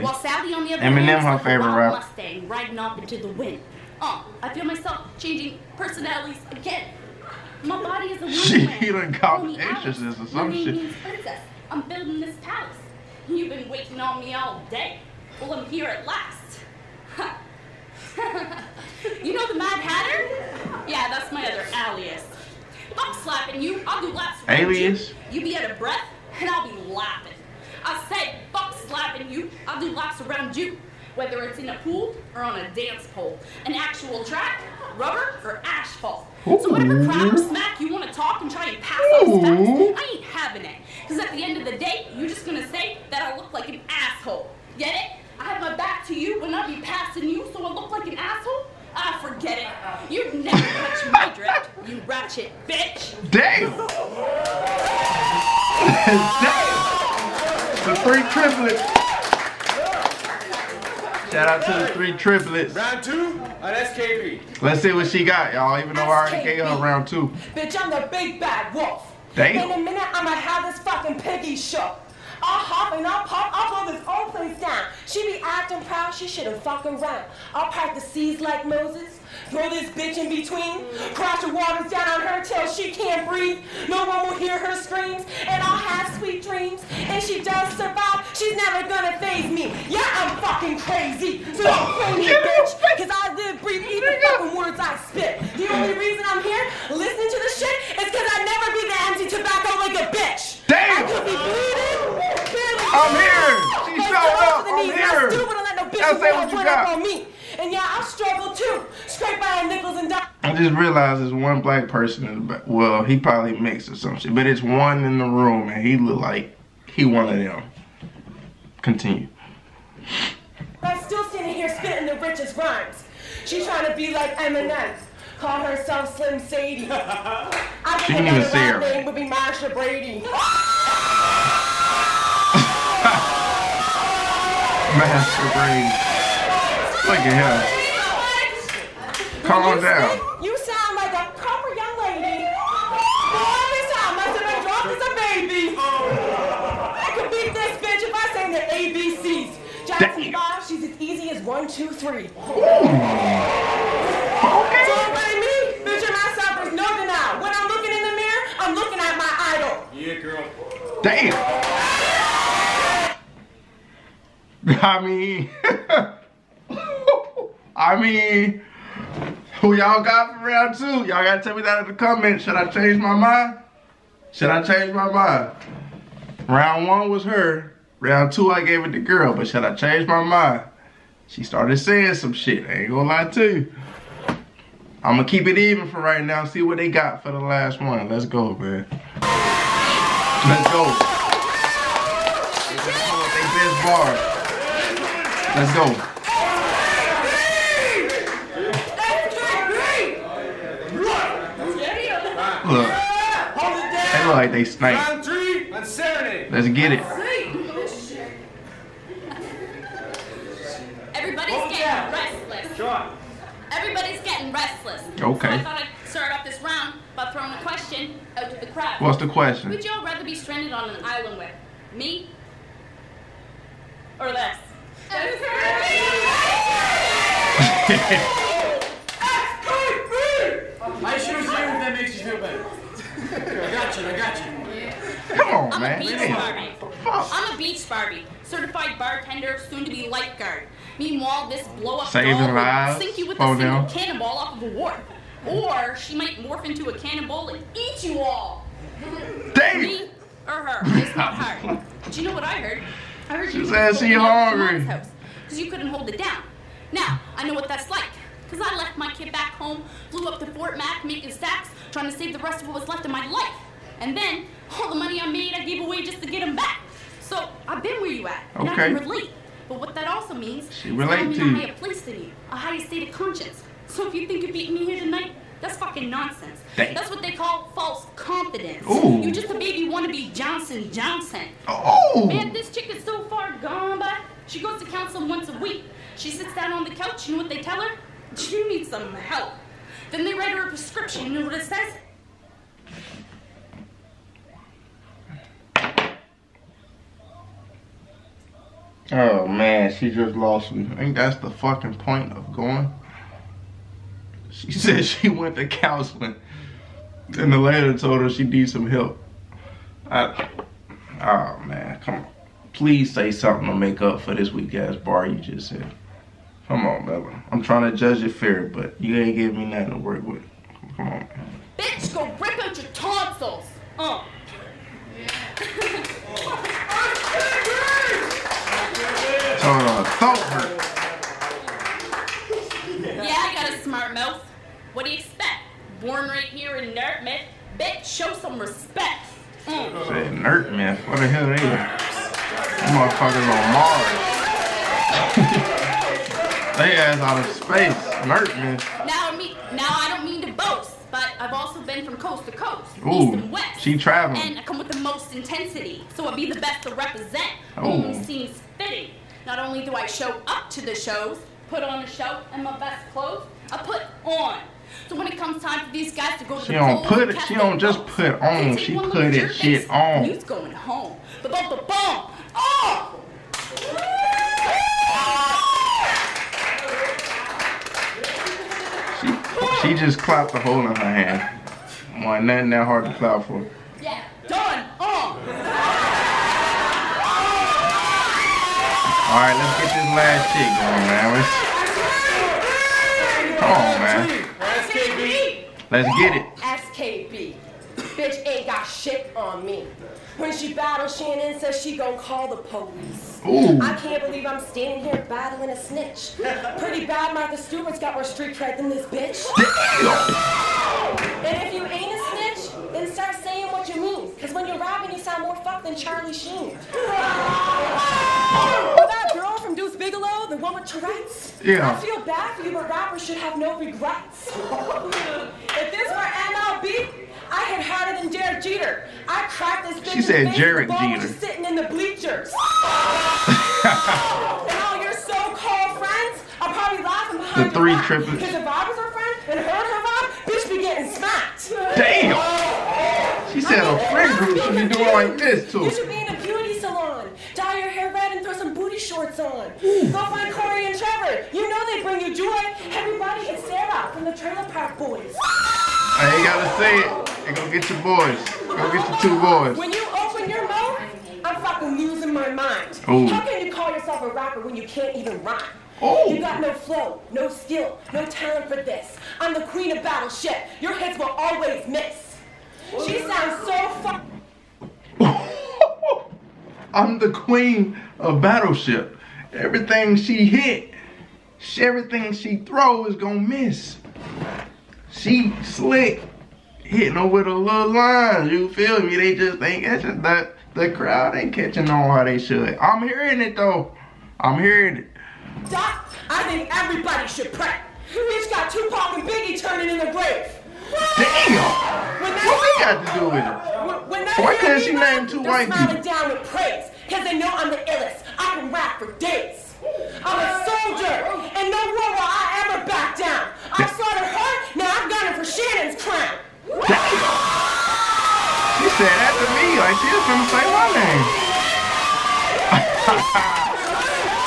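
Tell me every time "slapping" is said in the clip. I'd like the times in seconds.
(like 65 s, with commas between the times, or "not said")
23 s, 28 s.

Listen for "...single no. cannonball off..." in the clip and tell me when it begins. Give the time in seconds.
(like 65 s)
243 s.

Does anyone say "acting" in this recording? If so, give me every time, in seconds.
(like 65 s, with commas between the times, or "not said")
75 s.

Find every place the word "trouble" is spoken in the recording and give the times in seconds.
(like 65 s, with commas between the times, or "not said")
not said.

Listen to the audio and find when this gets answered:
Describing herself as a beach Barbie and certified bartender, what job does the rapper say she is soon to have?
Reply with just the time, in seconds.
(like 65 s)
240 s.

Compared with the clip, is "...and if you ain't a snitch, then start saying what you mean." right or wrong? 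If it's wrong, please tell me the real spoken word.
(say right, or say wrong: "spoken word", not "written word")
right.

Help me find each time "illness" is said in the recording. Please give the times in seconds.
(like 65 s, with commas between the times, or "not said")
not said.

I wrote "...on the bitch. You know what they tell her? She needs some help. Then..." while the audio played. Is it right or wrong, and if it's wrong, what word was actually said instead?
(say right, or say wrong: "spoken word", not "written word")
wrong: "couch", not "bitch".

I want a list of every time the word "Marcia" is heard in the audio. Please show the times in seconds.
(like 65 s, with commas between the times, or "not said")
129 s, 134 s.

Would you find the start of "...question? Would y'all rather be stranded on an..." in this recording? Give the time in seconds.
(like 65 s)
219 s.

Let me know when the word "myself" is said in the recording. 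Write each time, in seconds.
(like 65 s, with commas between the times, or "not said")
4 s, 156 s.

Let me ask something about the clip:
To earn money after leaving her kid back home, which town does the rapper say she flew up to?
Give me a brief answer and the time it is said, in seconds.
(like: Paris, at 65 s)
Fort Mac, at 260 s.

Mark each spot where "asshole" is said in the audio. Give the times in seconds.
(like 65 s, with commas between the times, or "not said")
43 s, 48 s.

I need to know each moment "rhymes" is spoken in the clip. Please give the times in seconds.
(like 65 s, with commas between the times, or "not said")
122 s, 465 s.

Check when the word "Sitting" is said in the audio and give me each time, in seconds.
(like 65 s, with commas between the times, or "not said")
431 s.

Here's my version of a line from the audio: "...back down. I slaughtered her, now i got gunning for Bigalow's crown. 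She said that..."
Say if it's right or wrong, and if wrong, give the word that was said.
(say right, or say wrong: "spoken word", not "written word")
wrong: "Shannon", not "Bigalow".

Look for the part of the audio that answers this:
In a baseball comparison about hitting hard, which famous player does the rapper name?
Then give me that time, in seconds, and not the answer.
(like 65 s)
428 s.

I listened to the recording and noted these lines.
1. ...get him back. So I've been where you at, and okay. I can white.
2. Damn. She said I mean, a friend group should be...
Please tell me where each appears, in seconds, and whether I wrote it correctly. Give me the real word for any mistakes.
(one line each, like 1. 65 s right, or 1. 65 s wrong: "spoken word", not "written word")
1. 266 s wrong: "relate", not "white"
2. 441 s right.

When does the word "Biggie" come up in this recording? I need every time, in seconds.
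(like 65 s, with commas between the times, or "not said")
499 s.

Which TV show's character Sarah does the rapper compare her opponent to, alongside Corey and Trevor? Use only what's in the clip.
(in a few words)
Trailer Park Boys.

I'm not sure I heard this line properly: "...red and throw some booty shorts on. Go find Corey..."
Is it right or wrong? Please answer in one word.
right.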